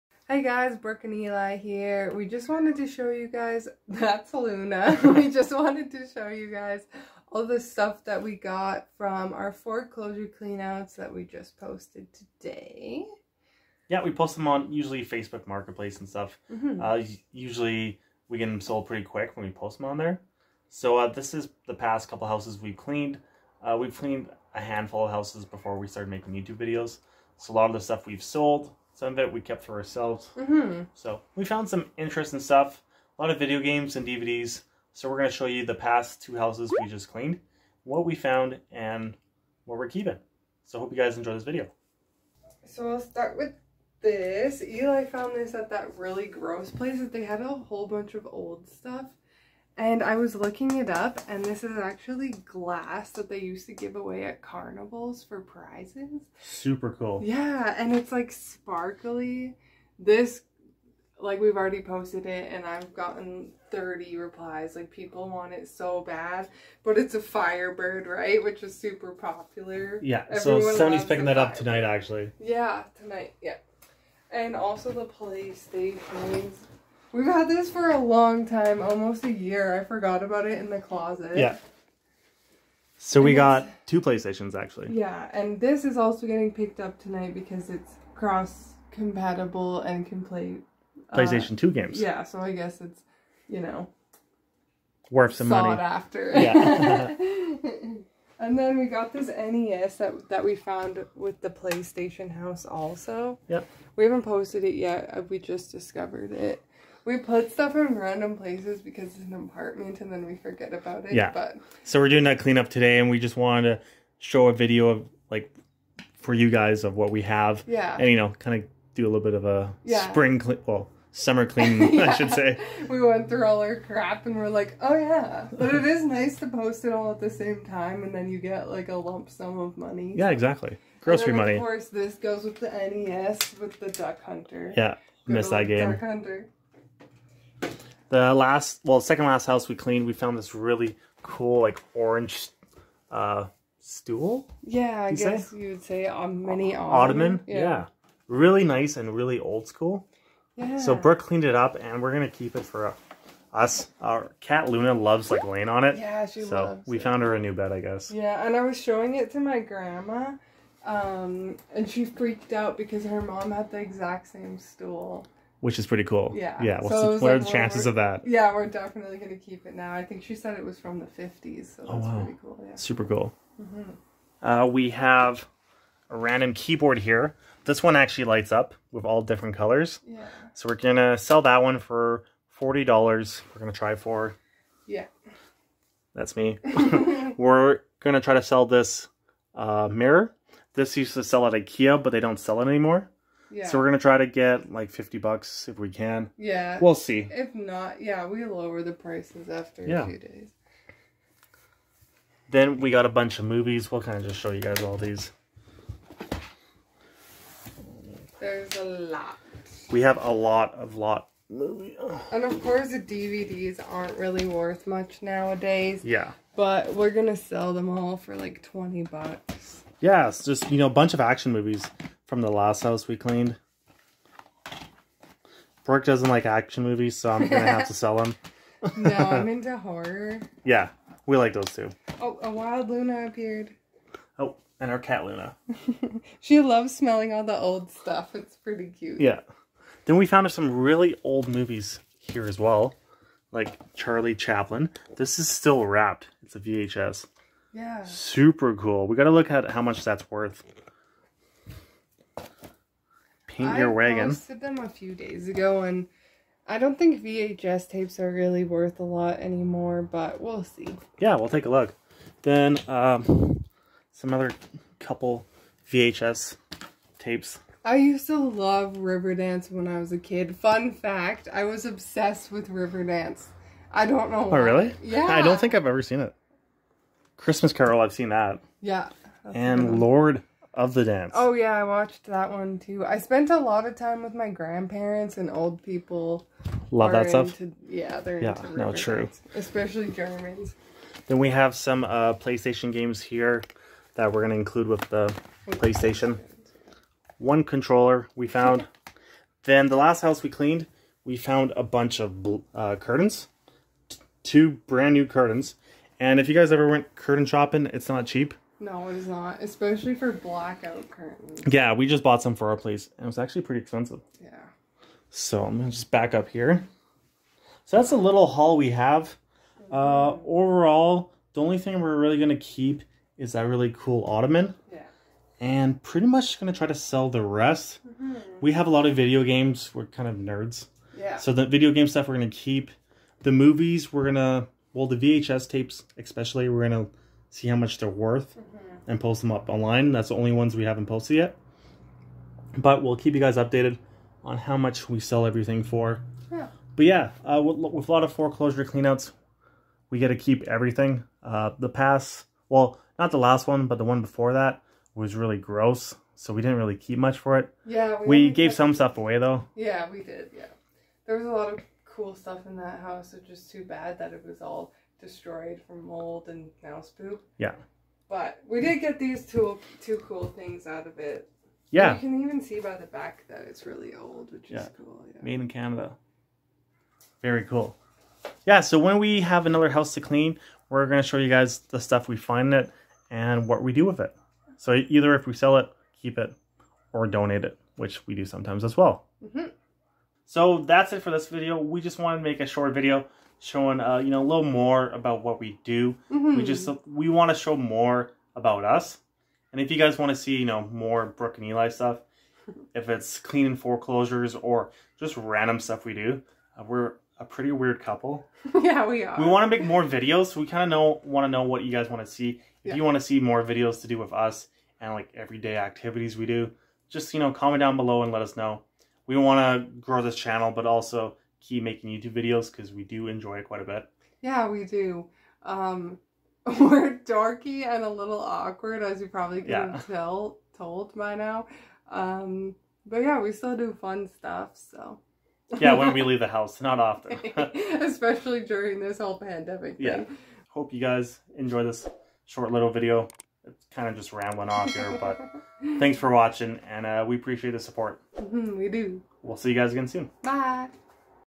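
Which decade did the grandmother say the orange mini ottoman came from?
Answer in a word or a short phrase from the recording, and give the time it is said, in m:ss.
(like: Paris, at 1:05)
the 50s, at 2:50.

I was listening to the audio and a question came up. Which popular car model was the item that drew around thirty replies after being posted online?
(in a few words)
Firebird.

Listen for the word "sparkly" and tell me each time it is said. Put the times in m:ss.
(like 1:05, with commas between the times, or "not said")
0:58.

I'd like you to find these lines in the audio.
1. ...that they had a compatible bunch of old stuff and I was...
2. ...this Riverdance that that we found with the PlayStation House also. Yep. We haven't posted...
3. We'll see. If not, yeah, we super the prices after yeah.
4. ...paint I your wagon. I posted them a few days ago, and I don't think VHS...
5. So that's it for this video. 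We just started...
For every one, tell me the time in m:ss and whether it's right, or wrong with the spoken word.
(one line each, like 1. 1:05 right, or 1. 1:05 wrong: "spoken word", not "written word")
1. 0:46 wrong: "whole", not "compatible"
2. 1:39 wrong: "NES", not "Riverdance"
3. 3:16 wrong: "lower", not "super"
4. 4:13 right
5. 6:30 wrong: "wanted", not "started".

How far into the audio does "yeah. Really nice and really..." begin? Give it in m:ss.
2:27.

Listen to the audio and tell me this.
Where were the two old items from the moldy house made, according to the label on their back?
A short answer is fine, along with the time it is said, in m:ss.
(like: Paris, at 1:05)
Canada, at 6:15.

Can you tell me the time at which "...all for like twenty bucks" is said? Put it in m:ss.
3:37.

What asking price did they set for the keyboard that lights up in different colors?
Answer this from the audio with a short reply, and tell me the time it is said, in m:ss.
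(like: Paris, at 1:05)
$40, at 3:02.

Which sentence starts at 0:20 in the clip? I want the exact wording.
So uh, this is the past couple houses we've cleaned.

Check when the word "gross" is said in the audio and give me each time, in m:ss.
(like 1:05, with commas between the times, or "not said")
0:46, 5:55.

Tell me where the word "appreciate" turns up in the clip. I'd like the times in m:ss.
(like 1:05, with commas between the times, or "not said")
7:27.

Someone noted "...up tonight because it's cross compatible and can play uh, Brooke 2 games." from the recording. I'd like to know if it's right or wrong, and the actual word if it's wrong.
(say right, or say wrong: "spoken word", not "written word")
wrong: "PlayStation", not "Brooke".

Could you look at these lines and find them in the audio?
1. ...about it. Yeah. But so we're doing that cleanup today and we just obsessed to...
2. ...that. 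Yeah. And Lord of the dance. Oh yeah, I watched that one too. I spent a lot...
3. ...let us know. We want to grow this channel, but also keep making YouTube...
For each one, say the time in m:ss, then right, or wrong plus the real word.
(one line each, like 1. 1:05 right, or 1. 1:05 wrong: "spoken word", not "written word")
1. 1:50 wrong: "wanted", not "obsessed"
2. 4:38 right
3. 6:58 right.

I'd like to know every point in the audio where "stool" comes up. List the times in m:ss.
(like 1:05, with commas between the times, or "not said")
2:23, 2:44.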